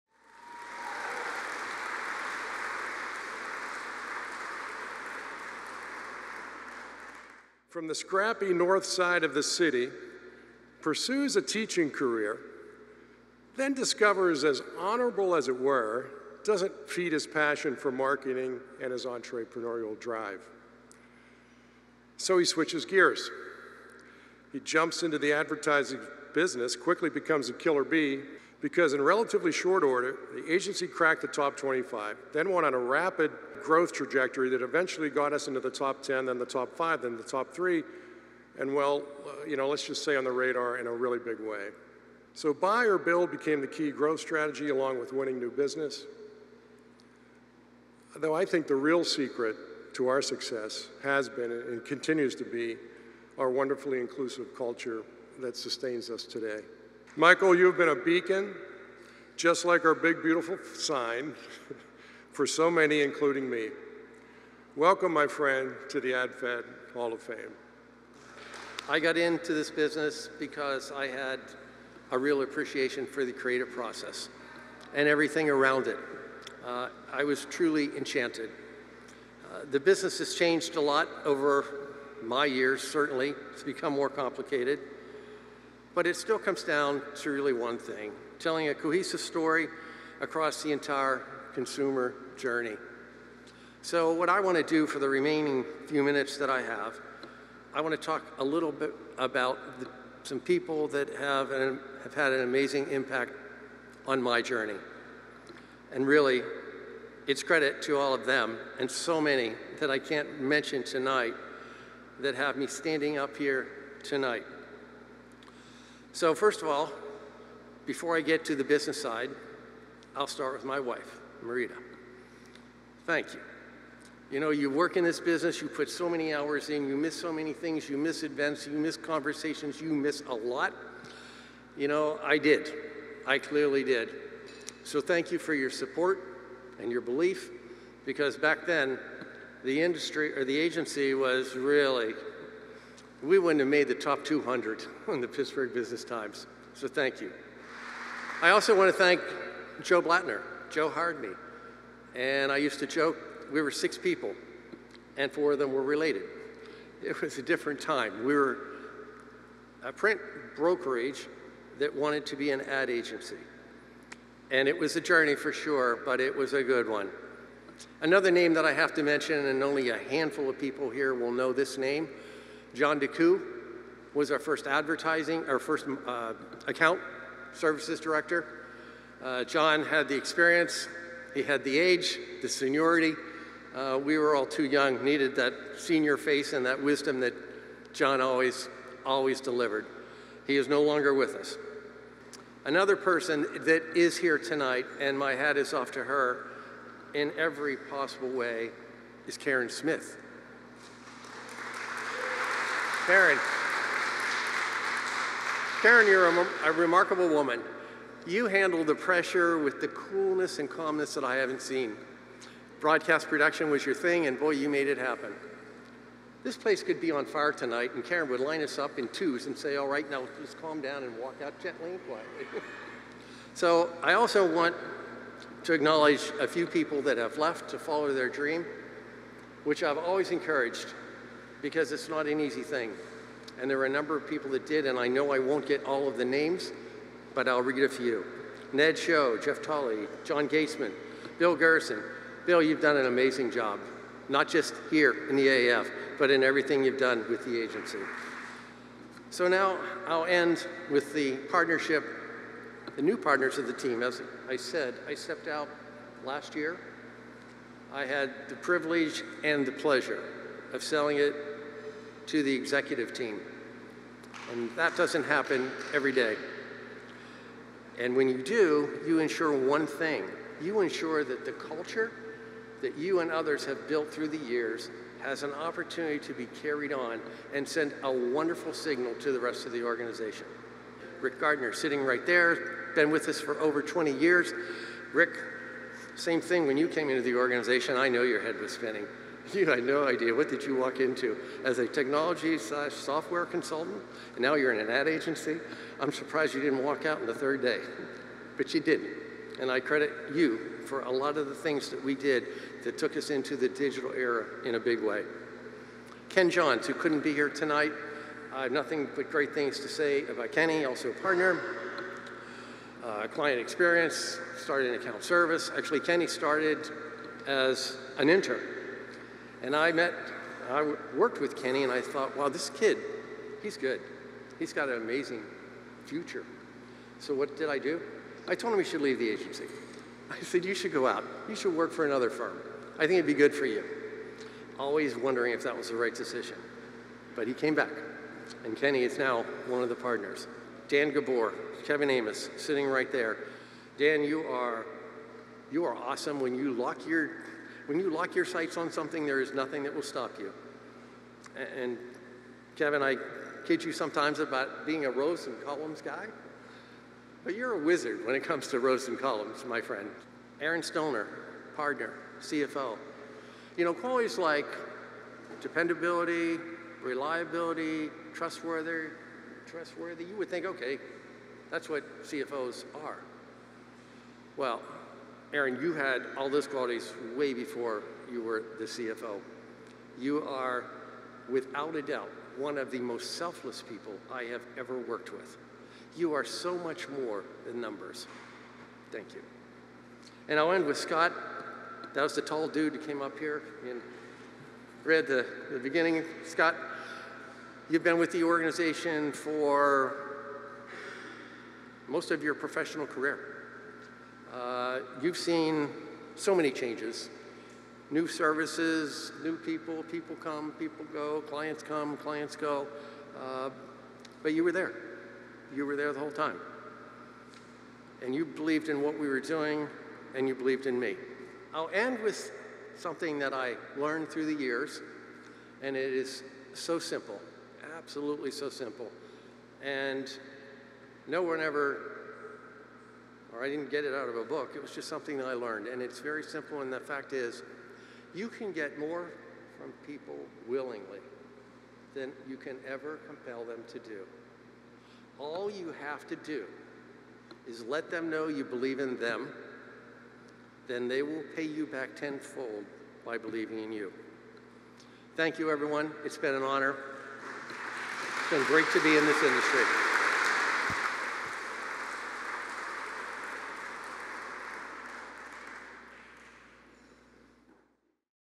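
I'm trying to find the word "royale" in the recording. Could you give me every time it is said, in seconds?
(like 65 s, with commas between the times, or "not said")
not said.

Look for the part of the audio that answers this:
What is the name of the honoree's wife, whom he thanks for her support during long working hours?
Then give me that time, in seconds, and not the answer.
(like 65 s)
121 s.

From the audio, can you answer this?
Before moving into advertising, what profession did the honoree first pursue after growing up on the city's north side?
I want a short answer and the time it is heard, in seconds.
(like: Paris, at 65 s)
Teaching, at 11 s.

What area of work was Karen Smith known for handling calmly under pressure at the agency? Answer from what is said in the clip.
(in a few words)
Broadcast production.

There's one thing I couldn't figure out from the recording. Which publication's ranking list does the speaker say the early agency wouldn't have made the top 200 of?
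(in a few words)
Pittsburgh Business Times.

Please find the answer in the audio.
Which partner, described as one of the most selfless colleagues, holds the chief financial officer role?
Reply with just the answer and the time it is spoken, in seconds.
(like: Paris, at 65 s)
Aaron Stoner, at 360 s.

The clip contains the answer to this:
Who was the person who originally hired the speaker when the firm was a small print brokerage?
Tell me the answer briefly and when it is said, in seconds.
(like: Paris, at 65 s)
Joe Blattner, at 149 s.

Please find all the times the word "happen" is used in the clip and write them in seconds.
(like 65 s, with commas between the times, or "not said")
214 s, 265 s.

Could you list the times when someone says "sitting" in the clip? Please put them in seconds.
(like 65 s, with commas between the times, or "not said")
281 s, 342 s.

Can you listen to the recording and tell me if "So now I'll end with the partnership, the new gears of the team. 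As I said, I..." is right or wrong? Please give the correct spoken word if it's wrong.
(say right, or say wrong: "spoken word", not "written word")
wrong: "partners", not "gears".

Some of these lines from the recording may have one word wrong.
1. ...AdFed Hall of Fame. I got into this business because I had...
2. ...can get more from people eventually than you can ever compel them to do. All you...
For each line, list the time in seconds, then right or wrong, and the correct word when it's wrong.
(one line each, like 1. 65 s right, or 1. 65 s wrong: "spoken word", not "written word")
1. 66 s right
2. 438 s wrong: "willingly", not "eventually".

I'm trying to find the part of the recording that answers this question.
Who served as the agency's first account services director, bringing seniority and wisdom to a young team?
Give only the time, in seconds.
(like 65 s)
172 s.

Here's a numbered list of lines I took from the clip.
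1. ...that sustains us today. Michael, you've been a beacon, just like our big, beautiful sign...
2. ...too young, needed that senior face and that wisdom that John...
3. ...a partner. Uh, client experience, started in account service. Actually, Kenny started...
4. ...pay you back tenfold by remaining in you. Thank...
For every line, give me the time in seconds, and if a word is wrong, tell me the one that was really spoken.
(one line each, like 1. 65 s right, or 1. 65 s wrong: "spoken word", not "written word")
1. 55 s right
2. 184 s right
3. 311 s right
4. 451 s wrong: "believing", not "remaining".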